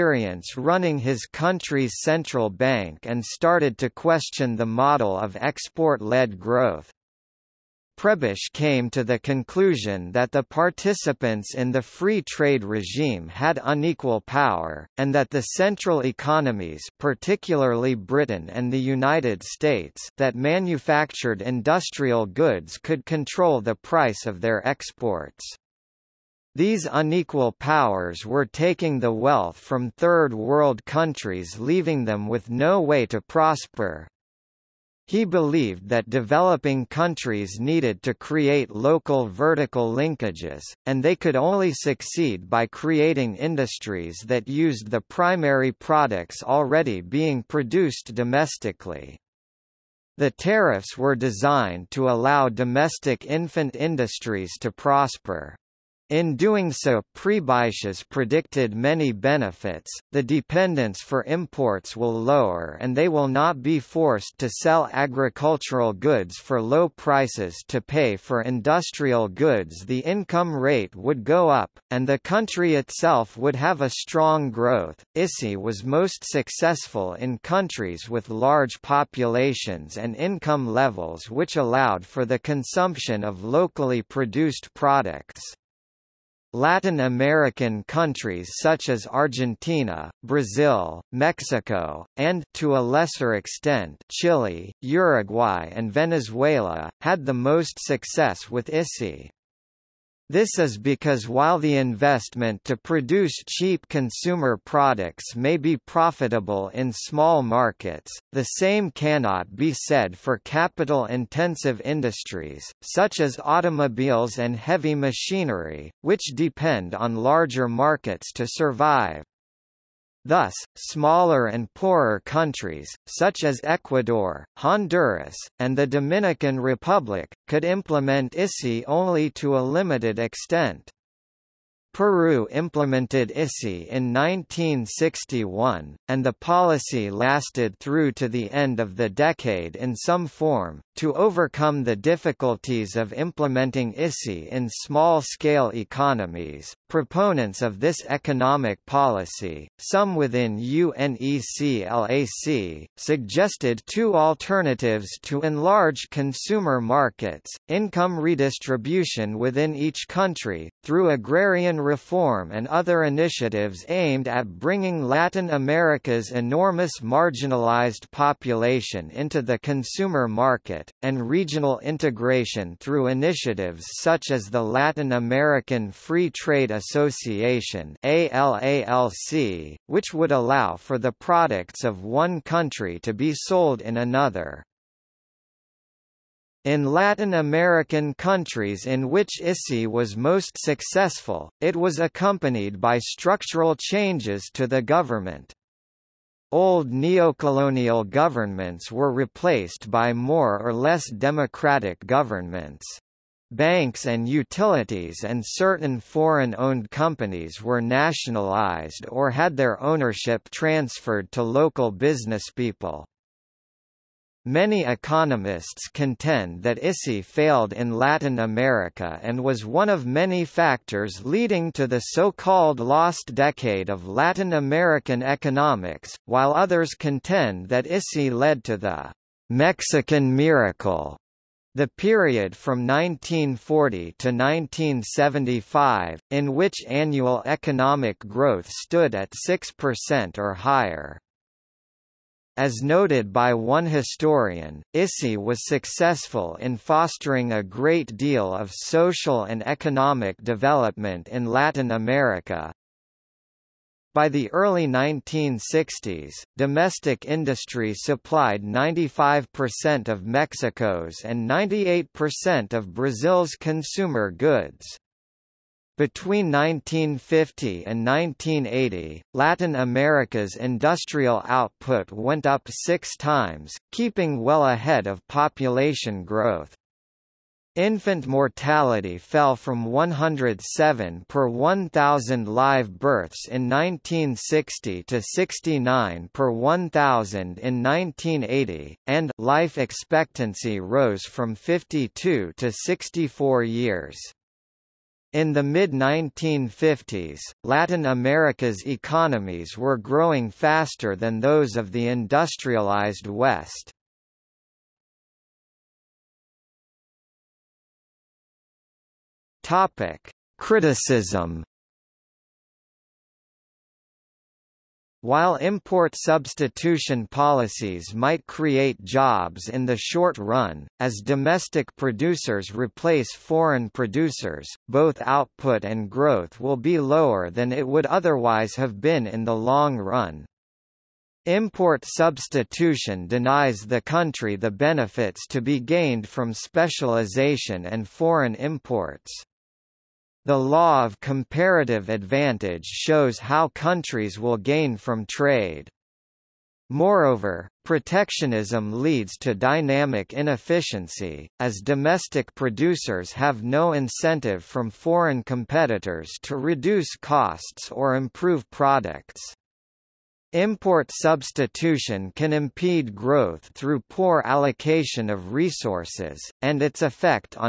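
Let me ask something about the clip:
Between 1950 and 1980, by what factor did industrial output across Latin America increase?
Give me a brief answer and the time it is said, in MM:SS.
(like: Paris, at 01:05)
6 times, at 04:32.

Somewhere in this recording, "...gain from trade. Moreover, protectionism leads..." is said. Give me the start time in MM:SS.
05:44.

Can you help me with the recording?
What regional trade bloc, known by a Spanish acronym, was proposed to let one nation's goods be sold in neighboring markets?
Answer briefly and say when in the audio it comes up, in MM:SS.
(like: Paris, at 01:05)
Latin American Free Trade Association, at 02:54.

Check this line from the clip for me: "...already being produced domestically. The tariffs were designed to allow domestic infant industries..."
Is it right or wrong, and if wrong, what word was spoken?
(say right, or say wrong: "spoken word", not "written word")
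right.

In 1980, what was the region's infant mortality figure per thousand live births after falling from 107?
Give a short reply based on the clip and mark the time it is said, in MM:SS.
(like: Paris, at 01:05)
69, at 04:45.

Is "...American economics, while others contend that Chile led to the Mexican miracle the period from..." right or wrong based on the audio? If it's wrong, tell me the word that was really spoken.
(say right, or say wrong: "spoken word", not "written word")
wrong: "ISI", not "Chile".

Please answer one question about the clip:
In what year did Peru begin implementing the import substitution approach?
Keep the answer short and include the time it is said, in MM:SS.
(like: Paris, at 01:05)
1961, at 02:14.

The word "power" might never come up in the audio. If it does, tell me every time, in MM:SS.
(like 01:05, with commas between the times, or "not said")
00:14, 00:27.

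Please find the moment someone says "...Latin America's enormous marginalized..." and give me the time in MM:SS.
02:45.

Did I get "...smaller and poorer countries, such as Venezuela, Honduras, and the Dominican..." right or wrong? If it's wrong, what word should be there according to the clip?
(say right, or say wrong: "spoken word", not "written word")
wrong: "Ecuador", not "Venezuela".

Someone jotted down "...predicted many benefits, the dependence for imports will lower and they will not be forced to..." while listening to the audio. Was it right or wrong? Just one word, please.
right.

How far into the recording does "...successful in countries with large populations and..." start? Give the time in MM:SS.
01:16.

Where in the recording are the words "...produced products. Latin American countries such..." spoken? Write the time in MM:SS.
01:24.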